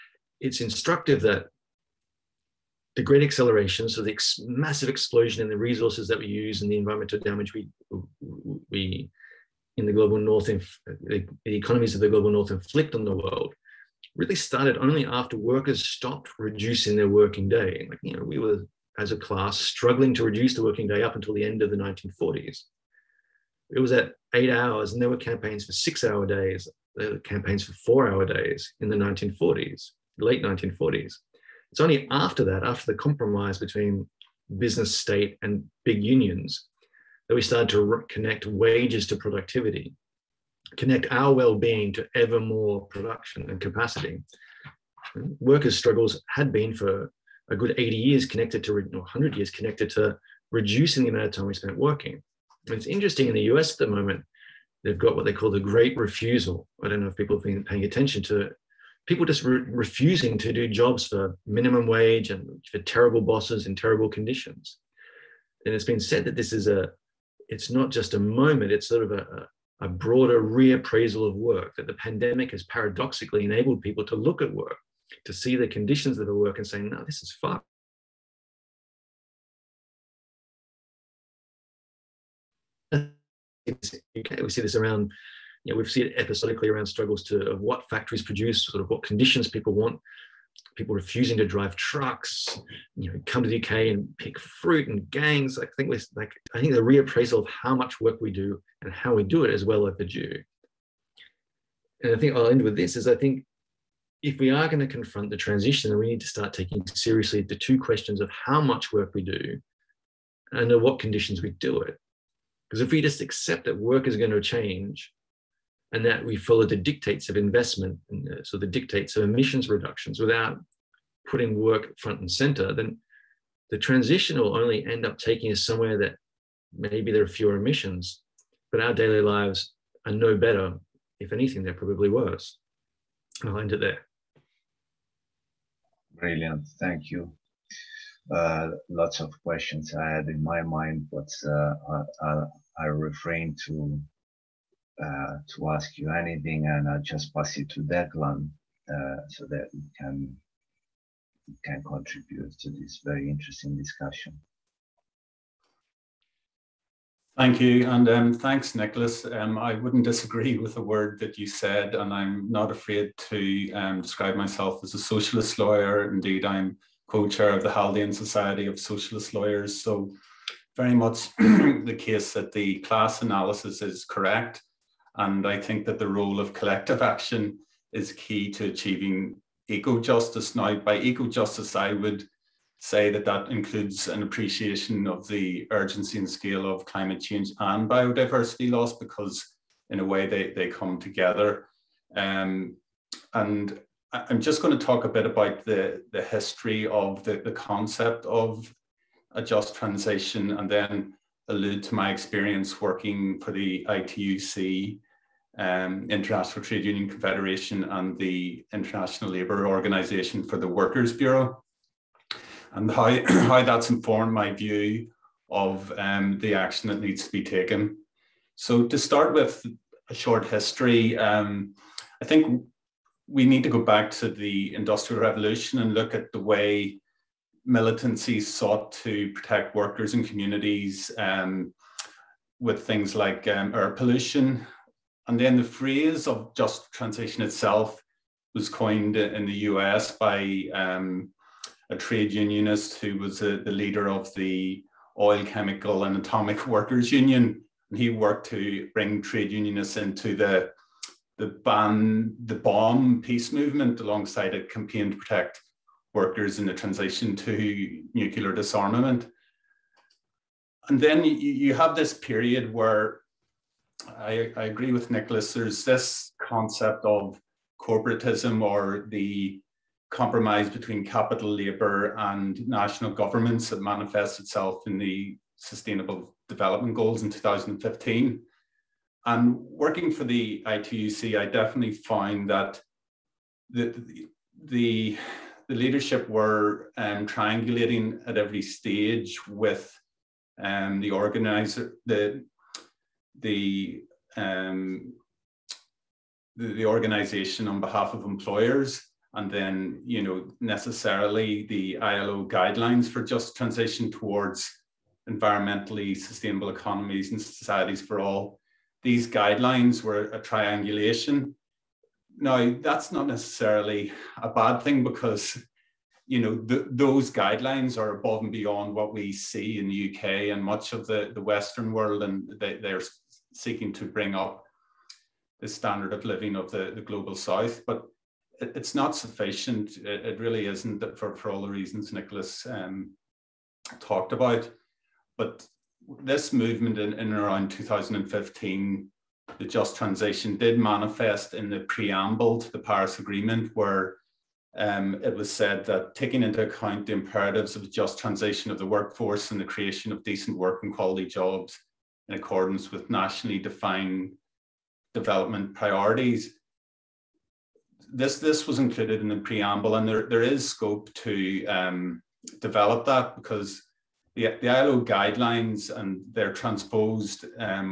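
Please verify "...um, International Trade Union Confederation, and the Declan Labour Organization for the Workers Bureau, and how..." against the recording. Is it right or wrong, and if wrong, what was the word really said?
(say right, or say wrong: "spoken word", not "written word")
wrong: "International", not "Declan".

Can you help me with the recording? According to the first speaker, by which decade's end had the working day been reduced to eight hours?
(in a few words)
1940s.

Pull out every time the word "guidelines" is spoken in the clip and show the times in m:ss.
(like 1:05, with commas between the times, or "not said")
5:02, 5:09, 5:17, 6:05.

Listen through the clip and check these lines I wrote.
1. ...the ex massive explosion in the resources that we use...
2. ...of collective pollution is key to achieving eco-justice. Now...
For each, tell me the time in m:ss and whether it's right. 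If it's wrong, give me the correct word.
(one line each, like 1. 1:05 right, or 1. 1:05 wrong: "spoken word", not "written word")
1. 0:04 right
2. 2:56 wrong: "action", not "pollution".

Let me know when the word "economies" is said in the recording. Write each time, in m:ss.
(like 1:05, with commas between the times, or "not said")
0:11, 5:06.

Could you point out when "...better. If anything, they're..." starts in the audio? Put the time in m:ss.
2:10.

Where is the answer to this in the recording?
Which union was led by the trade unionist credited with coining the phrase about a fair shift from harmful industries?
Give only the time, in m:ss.
4:05.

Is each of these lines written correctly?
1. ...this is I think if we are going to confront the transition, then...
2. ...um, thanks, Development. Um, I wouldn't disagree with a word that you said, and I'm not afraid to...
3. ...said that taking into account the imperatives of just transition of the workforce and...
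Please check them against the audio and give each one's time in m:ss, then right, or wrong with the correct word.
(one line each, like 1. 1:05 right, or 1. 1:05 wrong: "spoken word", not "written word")
1. 1:42 right
2. 2:38 wrong: "Nicholas", not "Development"
3. 5:45 right.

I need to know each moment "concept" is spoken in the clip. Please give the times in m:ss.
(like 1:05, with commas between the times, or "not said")
3:17, 4:26.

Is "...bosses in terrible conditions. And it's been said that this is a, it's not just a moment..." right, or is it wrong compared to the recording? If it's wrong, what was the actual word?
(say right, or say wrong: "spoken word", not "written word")
right.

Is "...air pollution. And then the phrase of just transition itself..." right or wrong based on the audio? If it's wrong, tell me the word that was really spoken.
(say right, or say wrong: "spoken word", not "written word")
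right.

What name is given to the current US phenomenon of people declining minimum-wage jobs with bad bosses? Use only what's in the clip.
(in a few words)
the great refusal.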